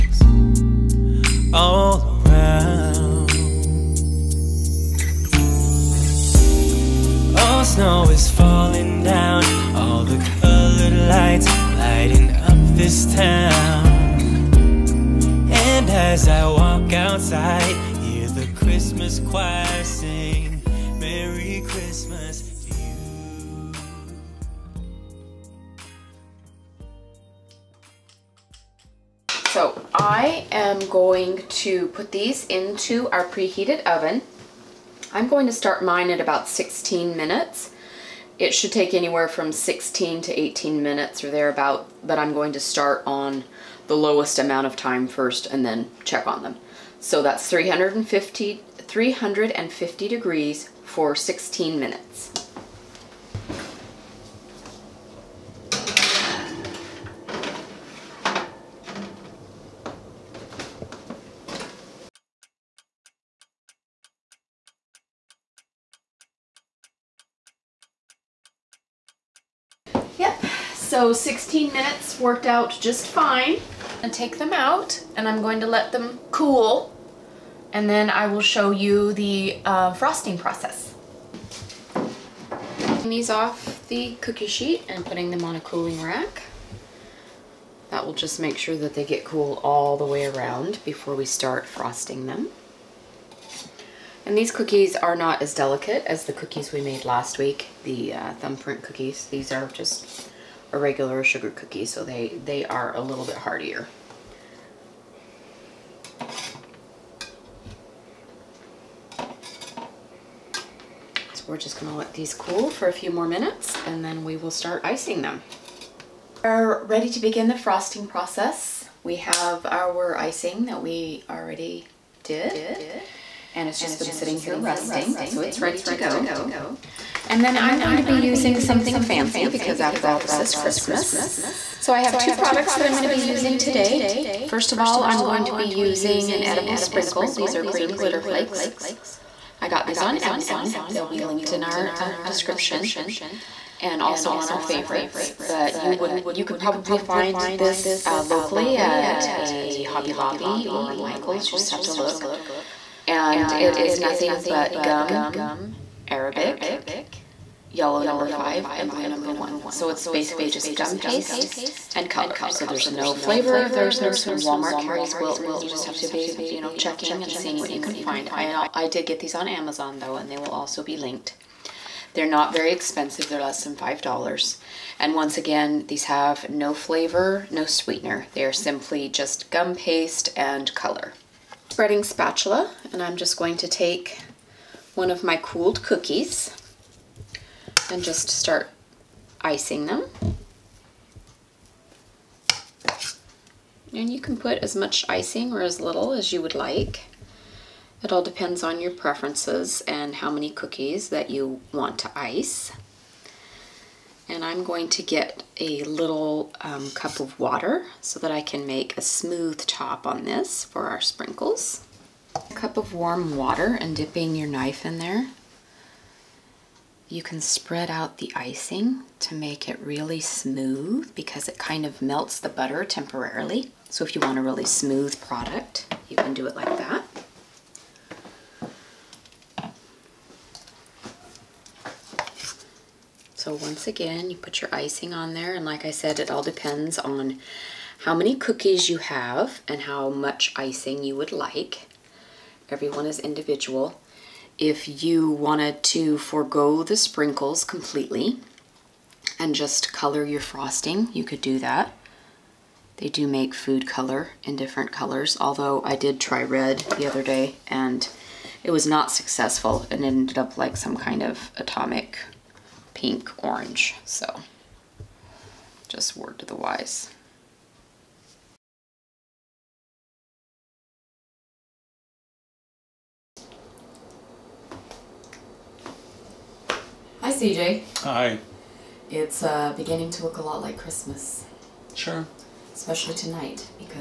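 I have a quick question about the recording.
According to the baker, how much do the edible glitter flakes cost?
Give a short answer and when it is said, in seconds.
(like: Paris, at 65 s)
less than $5, at 173 s.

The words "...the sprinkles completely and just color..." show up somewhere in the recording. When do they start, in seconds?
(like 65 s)
246 s.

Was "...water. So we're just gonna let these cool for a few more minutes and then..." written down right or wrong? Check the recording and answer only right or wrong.
wrong.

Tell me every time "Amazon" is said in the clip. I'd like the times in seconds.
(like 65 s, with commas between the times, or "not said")
140 s, 169 s.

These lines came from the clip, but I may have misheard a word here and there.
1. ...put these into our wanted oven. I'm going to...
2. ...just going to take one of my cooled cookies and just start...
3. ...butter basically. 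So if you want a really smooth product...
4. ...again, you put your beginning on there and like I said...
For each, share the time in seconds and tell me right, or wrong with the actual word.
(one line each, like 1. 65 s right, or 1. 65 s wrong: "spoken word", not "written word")
1. 31 s wrong: "preheated", not "wanted"
2. 183 s right
3. 222 s wrong: "temporarily", not "basically"
4. 233 s wrong: "icing", not "beginning".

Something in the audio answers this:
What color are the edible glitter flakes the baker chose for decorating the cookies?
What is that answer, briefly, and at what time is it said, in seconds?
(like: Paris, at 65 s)
green, at 137 s.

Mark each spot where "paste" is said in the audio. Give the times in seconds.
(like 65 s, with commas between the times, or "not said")
160 s, 179 s.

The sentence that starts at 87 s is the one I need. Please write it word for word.
That will just make sure that they get cool all the way around before we start frosting them.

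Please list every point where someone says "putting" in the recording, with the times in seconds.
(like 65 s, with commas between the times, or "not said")
85 s.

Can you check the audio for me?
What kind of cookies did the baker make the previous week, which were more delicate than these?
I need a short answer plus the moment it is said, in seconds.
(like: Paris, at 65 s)
thumbprint cookies, at 98 s.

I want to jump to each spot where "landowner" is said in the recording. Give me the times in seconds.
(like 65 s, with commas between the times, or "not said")
not said.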